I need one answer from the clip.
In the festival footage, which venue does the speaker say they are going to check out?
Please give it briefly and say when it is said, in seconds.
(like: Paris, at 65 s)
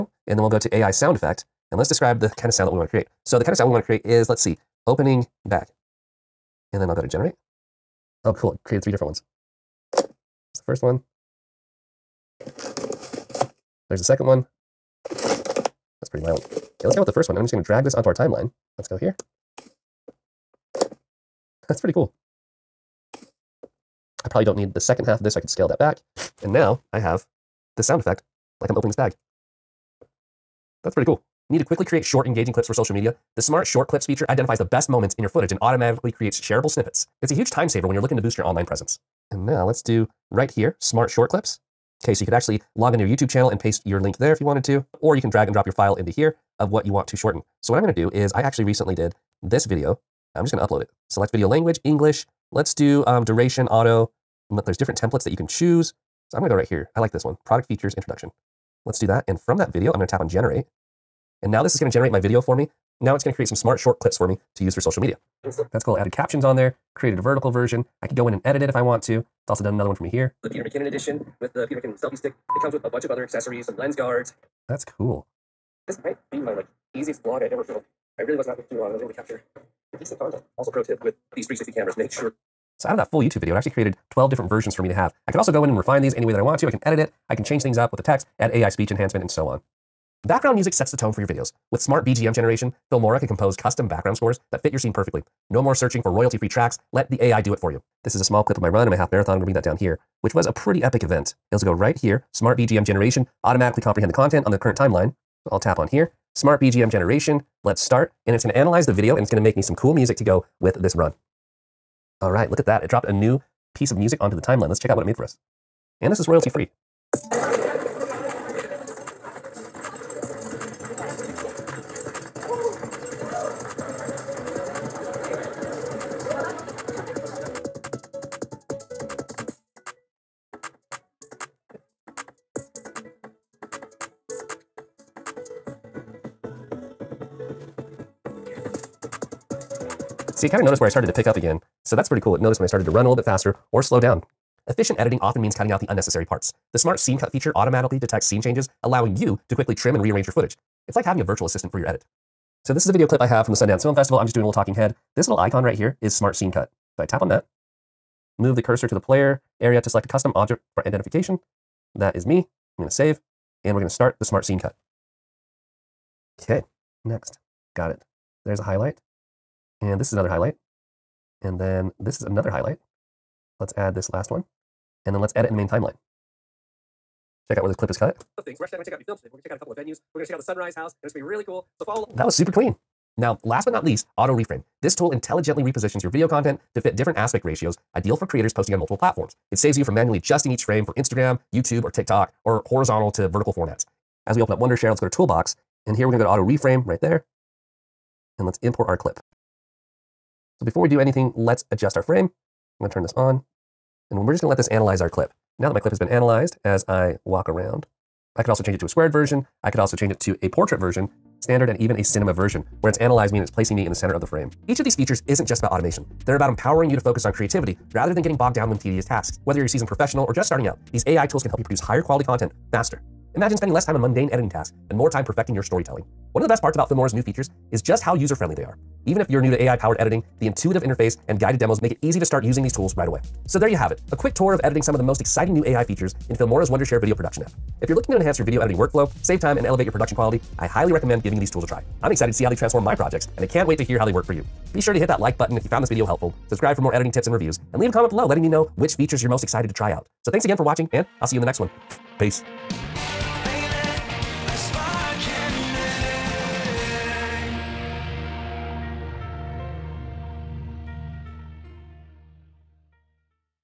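Sunrise House, at 180 s.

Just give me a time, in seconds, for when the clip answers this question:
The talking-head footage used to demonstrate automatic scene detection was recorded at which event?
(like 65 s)
153 s.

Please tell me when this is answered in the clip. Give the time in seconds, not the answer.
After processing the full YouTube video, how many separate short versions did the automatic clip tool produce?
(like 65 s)
84 s.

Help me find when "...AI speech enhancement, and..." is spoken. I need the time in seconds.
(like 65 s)
88 s.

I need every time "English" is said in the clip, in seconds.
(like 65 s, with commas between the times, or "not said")
51 s.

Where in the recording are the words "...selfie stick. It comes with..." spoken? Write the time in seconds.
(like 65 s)
71 s.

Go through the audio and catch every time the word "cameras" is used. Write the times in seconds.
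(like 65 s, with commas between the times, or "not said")
81 s.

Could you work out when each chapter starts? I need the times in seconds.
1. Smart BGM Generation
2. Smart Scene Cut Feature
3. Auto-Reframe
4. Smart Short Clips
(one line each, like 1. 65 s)
1. 90 s
2. 145 s
3. 183 s
4. 30 s.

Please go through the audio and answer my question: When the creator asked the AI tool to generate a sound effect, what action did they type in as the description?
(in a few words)
Opening bag.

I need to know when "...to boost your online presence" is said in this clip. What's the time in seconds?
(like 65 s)
38 s.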